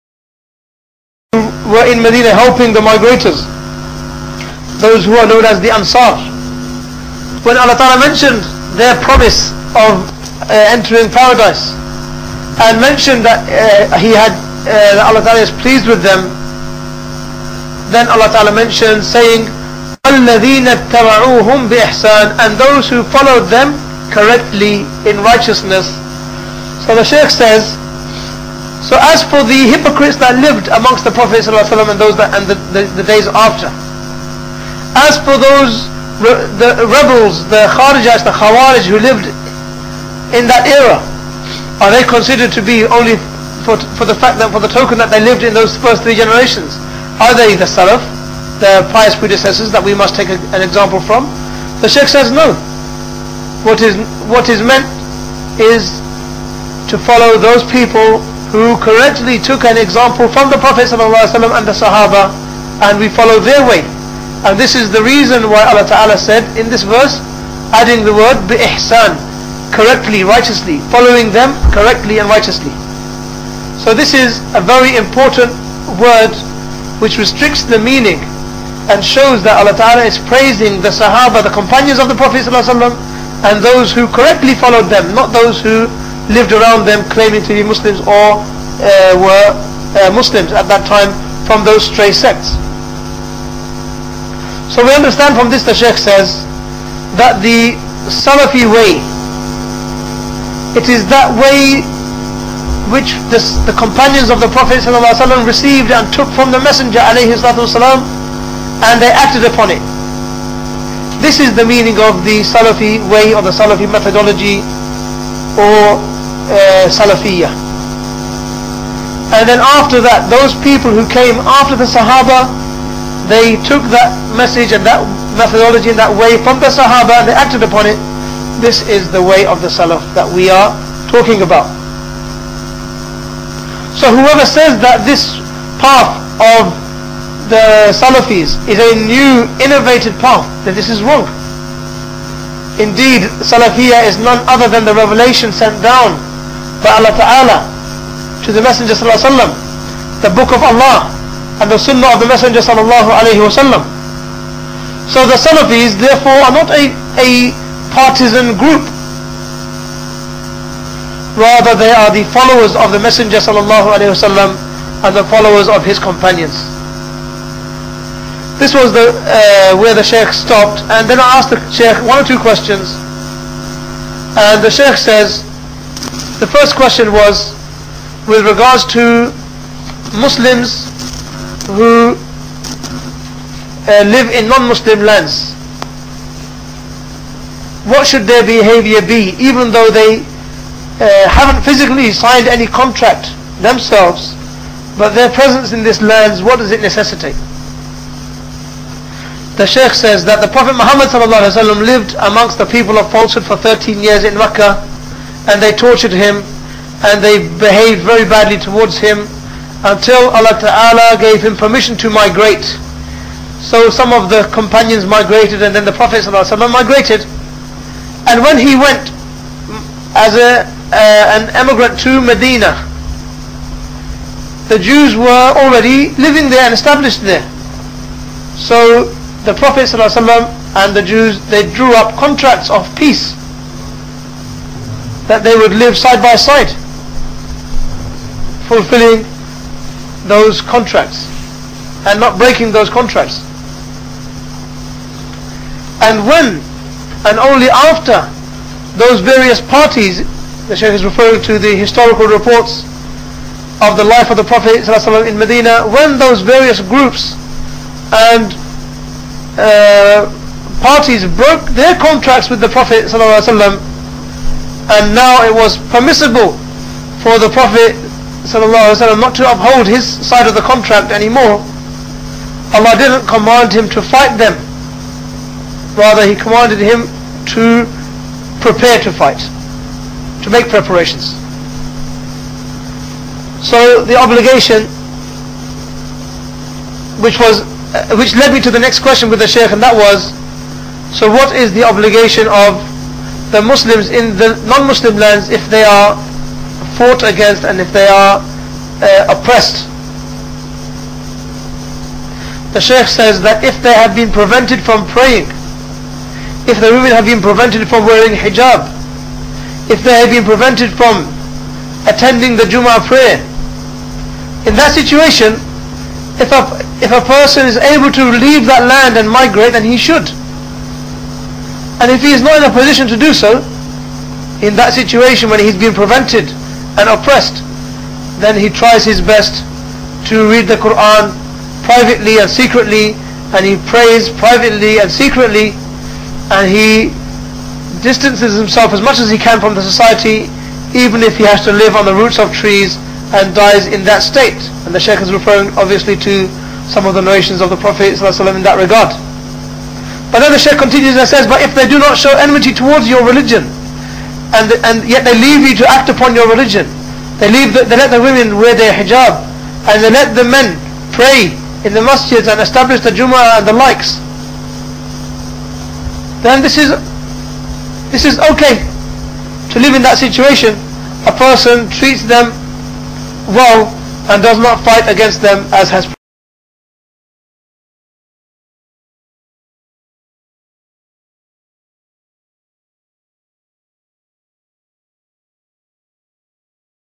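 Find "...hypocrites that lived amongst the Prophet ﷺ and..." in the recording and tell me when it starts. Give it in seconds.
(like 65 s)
29 s.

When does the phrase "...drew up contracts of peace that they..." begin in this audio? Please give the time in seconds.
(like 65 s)
231 s.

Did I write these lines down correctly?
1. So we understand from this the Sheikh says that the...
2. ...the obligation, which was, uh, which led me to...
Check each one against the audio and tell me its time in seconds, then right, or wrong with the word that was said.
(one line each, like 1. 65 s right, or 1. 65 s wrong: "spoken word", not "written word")
1. 94 s right
2. 284 s right.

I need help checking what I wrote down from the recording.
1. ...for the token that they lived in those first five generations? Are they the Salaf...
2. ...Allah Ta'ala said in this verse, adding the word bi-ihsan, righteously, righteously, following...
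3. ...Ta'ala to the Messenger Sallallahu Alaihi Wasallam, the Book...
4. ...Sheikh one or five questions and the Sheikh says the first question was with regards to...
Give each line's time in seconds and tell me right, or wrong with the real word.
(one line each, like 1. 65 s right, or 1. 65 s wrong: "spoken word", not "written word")
1. 44 s wrong: "three", not "five"
2. 65 s wrong: "correctly", not "righteously"
3. 147 s right
4. 171 s wrong: "two", not "five".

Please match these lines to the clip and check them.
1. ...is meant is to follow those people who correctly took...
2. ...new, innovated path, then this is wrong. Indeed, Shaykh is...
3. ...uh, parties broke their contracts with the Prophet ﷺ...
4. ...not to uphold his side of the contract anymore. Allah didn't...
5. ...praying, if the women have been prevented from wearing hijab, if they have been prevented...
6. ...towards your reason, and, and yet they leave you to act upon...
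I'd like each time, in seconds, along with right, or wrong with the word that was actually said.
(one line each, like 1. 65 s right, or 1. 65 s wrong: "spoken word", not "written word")
1. 54 s right
2. 139 s wrong: "Salafiyah", not "Shaykh"
3. 259 s right
4. 269 s right
5. 305 s right
6. 352 s wrong: "religion", not "reason".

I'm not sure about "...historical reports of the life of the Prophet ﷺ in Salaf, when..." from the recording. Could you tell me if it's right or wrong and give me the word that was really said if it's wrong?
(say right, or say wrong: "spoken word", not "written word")
wrong: "Medina", not "Salaf".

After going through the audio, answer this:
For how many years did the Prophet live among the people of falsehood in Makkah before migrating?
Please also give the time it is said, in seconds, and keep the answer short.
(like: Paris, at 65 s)
13, at 203 s.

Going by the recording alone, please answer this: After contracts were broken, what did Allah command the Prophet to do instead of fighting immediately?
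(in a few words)
prepare to fight.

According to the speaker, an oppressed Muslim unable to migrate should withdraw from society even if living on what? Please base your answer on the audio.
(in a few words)
roots of trees.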